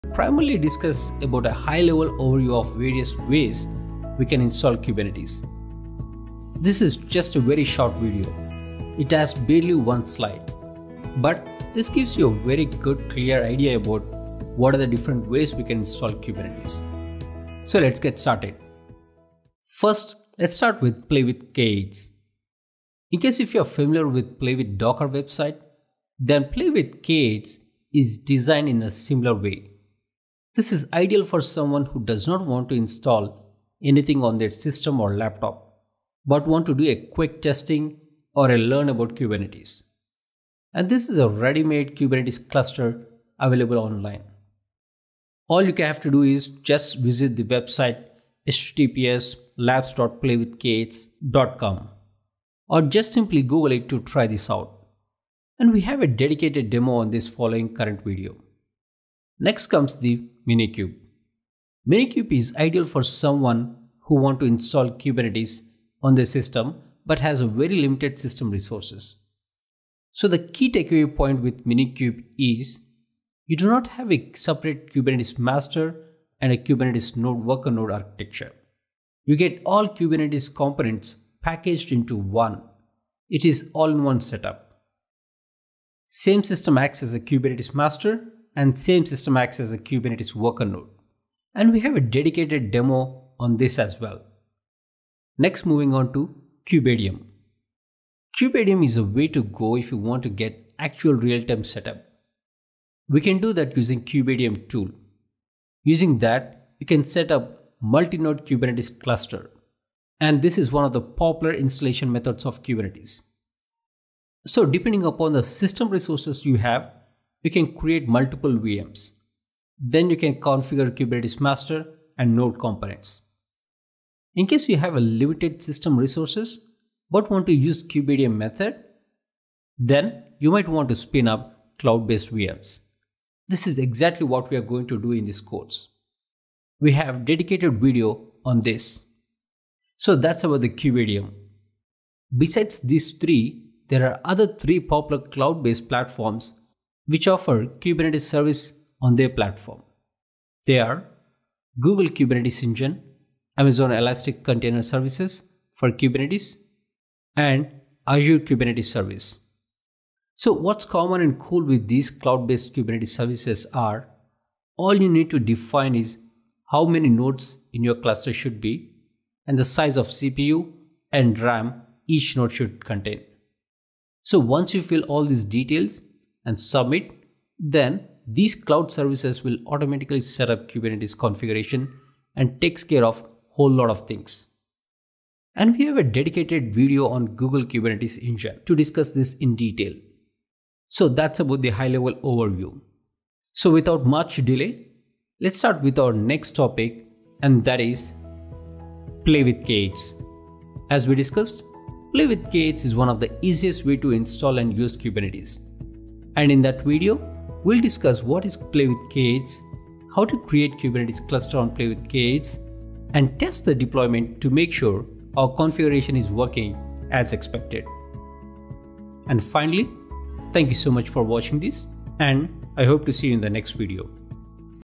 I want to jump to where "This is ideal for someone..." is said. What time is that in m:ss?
0:30.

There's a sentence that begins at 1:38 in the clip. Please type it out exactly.
kubeadm is a way to go if you want to get actual real-time setup.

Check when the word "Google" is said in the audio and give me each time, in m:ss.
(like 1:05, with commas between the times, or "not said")
0:53, 2:31, 3:07.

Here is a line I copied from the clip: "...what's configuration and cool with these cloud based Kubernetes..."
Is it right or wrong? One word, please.
wrong.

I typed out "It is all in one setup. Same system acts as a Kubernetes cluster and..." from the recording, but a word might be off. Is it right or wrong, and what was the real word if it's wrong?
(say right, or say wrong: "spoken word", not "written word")
wrong: "master", not "cluster".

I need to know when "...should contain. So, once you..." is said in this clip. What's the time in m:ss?
2:52.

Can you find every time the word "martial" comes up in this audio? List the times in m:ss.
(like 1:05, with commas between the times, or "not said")
not said.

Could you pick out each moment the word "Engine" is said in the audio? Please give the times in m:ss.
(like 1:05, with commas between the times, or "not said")
2:32, 3:08.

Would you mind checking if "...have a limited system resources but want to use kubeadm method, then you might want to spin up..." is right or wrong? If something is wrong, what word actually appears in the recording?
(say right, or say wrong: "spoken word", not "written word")
right.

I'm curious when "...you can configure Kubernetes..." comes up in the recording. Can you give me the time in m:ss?
2:00.